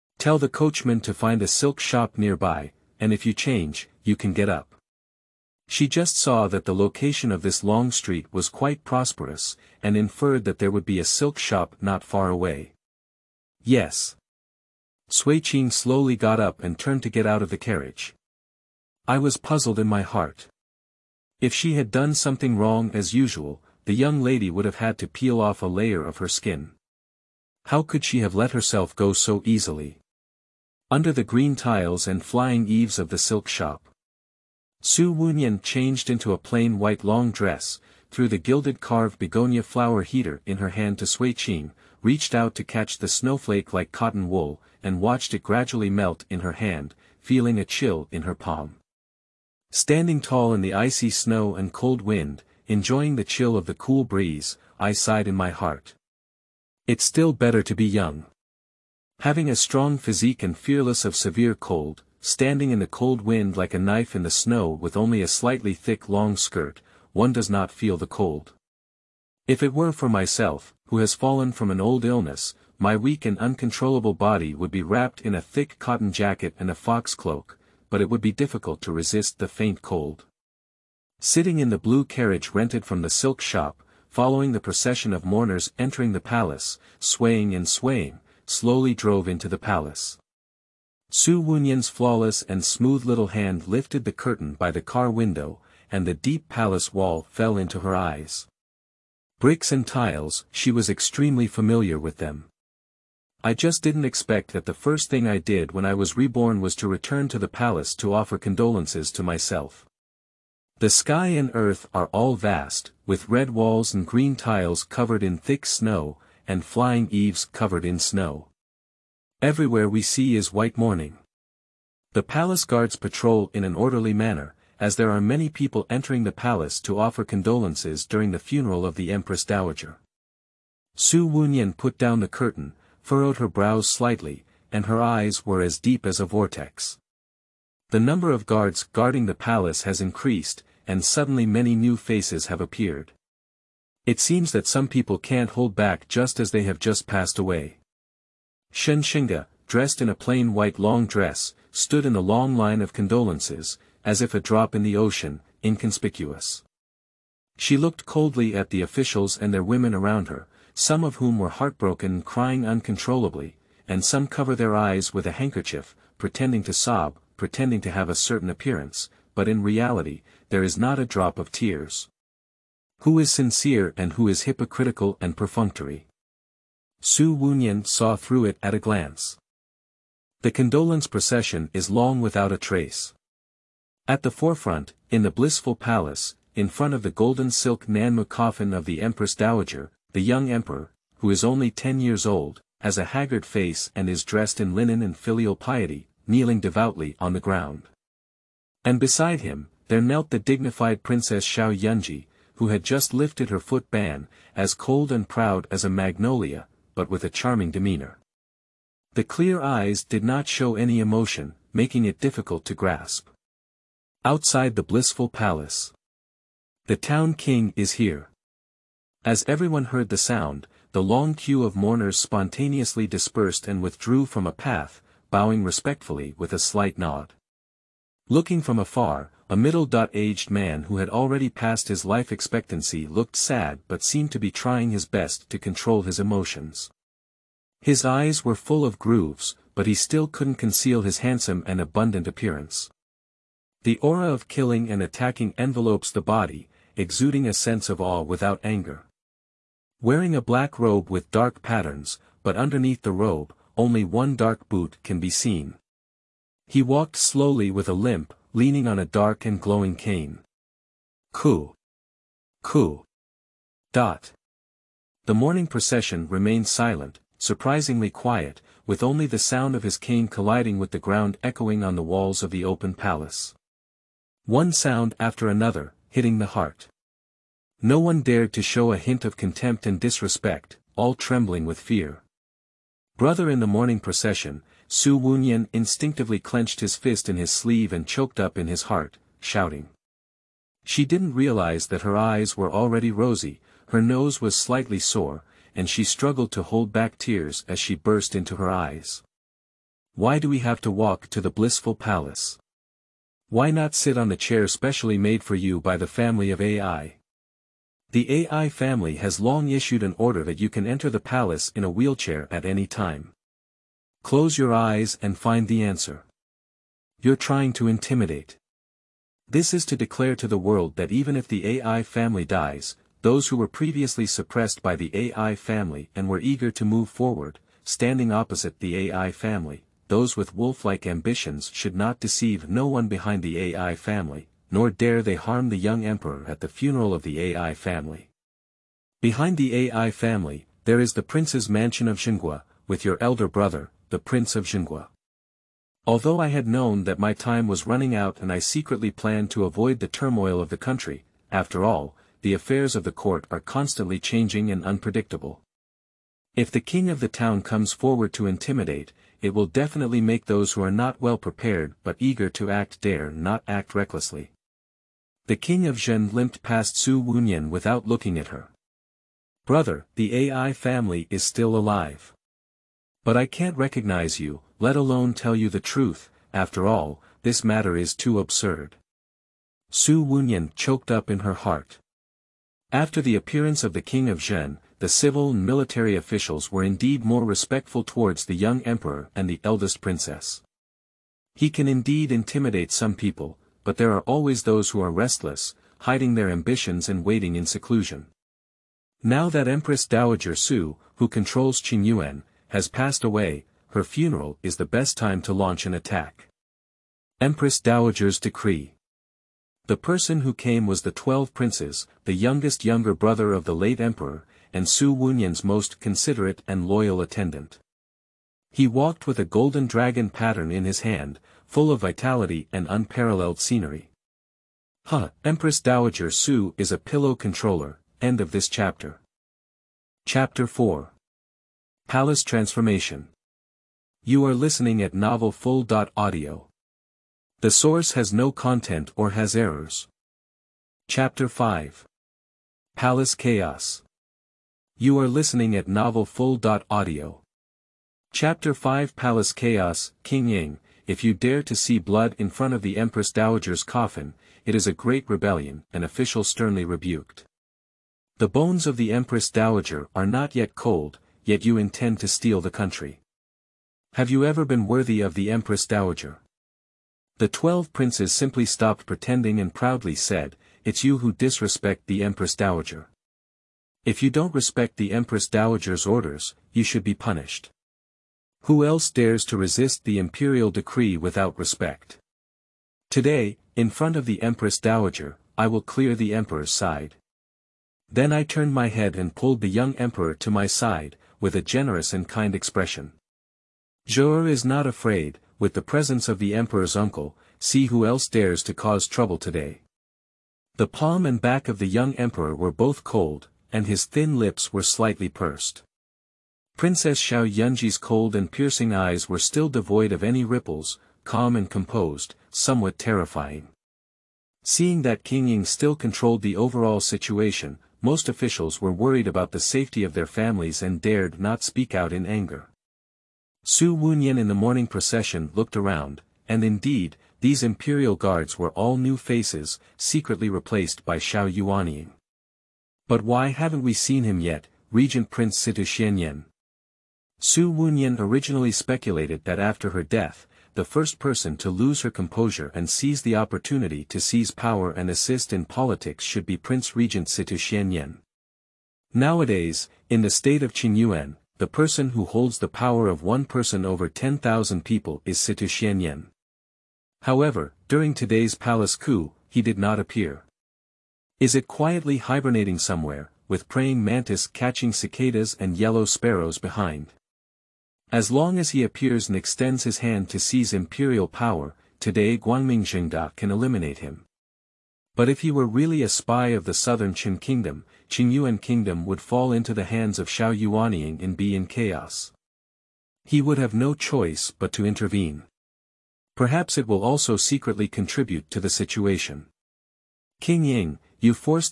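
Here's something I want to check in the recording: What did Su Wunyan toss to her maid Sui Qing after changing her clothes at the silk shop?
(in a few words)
Gilded carved begonia flower heater.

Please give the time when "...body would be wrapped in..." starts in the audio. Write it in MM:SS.
01:14.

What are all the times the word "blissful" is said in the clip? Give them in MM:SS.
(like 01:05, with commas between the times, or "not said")
03:05, 03:34, 05:01.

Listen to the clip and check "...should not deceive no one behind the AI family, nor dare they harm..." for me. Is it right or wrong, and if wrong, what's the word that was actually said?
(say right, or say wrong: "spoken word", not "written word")
right.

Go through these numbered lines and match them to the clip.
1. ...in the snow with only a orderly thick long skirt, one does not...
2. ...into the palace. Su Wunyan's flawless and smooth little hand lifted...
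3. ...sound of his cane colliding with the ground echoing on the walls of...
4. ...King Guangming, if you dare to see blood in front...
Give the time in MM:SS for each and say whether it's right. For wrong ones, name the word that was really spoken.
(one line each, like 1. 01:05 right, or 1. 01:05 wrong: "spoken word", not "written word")
1. 01:04 wrong: "slightly", not "orderly"
2. 01:29 right
3. 04:29 right
4. 07:30 wrong: "Ying", not "Guangming".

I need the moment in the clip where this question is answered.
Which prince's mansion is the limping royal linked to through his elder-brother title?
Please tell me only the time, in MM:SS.
05:42.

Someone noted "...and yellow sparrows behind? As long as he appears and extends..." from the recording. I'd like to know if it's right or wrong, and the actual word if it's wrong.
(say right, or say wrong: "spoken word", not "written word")
right.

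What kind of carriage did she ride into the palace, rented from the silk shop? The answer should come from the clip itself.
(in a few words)
Blue carriage.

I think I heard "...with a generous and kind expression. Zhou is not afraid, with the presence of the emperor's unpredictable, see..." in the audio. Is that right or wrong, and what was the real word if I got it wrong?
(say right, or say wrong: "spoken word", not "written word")
wrong: "uncle", not "unpredictable".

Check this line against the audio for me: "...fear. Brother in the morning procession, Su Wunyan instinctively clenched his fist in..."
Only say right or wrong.
right.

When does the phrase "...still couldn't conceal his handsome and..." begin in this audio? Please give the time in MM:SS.
03:59.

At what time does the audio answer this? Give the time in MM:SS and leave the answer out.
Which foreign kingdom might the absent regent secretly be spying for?
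09:36.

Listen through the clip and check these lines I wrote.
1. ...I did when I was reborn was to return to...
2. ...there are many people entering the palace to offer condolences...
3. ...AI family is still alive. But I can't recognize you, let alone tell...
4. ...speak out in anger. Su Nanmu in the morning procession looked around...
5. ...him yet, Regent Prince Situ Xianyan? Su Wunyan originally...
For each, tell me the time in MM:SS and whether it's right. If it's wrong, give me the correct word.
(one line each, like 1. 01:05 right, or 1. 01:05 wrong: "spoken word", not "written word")
1. 01:45 right
2. 02:04 right
3. 06:10 right
4. 08:41 wrong: "Wunyan", not "Nanmu"
5. 08:54 right.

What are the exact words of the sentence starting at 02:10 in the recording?
Su Wunyan put down the curtain, furrowed her brows slightly, and her eyes were as deep as a vortex.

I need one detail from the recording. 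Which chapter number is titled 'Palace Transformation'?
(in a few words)
Chapter 4.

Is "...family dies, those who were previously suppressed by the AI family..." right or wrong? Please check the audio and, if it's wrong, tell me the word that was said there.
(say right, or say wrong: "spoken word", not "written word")
right.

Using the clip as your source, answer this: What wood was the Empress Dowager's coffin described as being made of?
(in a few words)
Golden silk Nanmu.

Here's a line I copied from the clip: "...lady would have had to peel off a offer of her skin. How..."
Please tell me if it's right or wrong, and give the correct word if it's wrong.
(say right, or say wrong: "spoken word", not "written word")
wrong: "layer", not "offer".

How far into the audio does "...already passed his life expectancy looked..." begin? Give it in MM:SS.
03:51.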